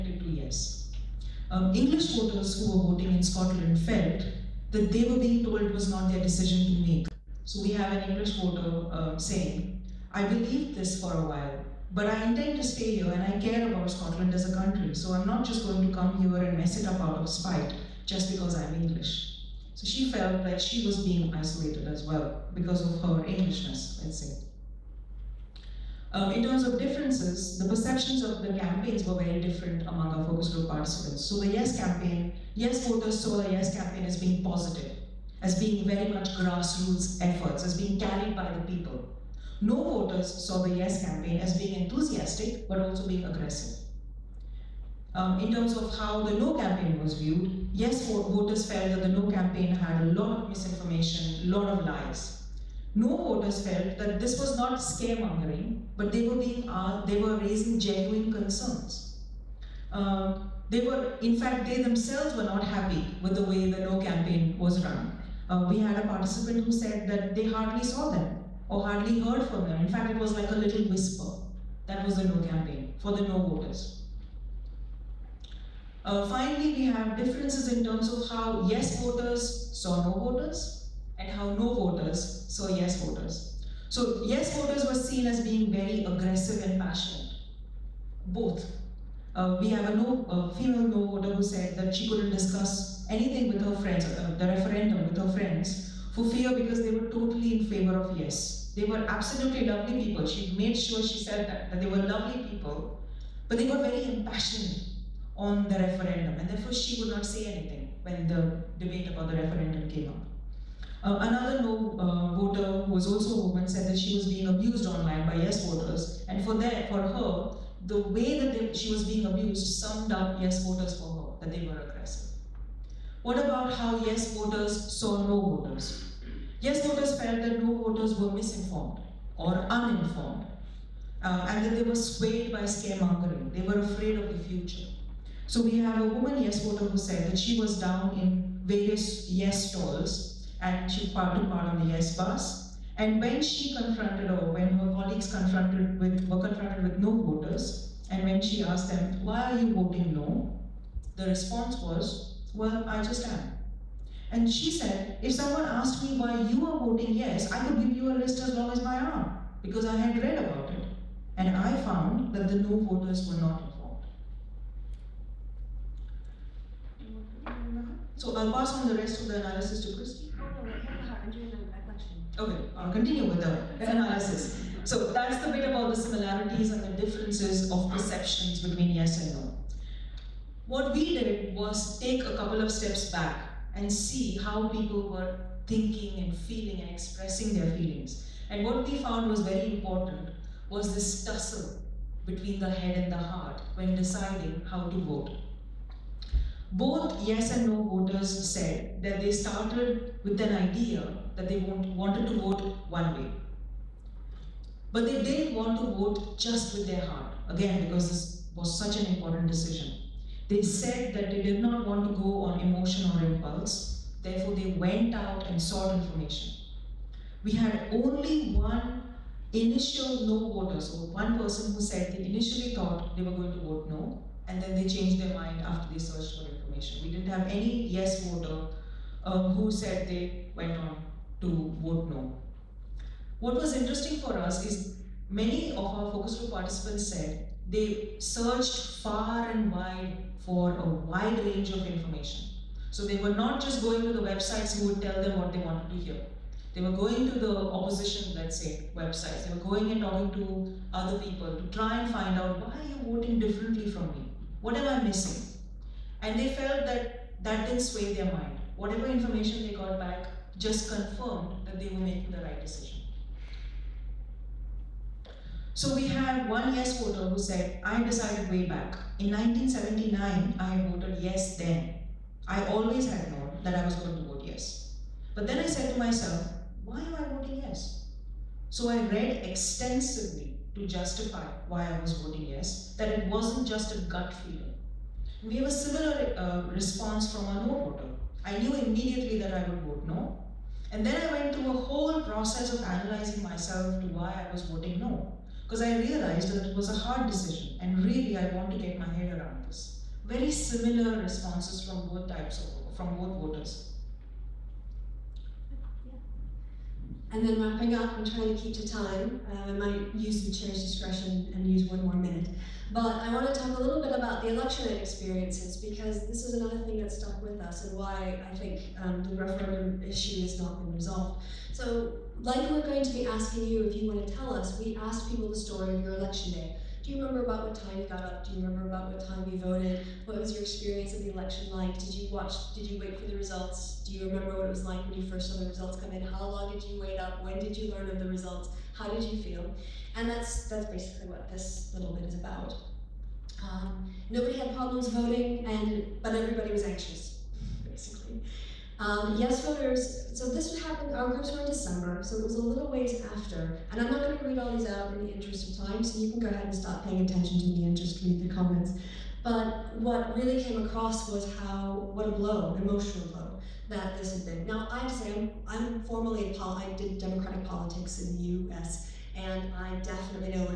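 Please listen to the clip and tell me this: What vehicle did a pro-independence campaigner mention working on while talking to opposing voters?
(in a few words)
the yes bus.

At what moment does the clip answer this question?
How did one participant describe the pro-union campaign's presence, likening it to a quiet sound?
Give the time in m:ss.
1:10.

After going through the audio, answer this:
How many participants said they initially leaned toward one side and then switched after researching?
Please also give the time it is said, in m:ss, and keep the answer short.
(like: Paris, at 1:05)
1, at 3:37.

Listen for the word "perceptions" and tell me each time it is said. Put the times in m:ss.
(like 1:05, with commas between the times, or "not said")
0:27, 2:57.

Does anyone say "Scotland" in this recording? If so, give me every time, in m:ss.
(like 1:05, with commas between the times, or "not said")
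0:03, 0:13.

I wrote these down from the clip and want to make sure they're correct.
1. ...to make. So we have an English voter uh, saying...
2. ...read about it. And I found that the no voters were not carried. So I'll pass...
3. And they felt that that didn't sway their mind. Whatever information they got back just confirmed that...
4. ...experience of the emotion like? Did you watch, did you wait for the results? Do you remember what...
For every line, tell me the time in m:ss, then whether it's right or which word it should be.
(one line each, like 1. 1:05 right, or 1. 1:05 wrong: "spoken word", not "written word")
1. 0:06 right
2. 2:40 wrong: "informed", not "carried"
3. 4:16 right
4. 5:30 wrong: "election", not "emotion".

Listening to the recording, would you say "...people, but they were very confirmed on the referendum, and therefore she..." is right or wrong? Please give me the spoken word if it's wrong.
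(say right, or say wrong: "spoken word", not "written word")
wrong: "impassioned", not "confirmed".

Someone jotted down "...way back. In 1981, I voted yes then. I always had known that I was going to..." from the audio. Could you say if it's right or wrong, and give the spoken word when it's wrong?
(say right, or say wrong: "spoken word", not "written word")
wrong: "1979", not "1981".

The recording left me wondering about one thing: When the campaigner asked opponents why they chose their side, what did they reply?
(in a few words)
well, I just am.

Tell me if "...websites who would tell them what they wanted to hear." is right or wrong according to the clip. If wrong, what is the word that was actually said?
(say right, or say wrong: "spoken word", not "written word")
right.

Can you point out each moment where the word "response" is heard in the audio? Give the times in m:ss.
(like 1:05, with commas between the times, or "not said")
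2:31, 4:46, 5:01.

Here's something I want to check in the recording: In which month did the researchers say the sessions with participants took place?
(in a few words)
December.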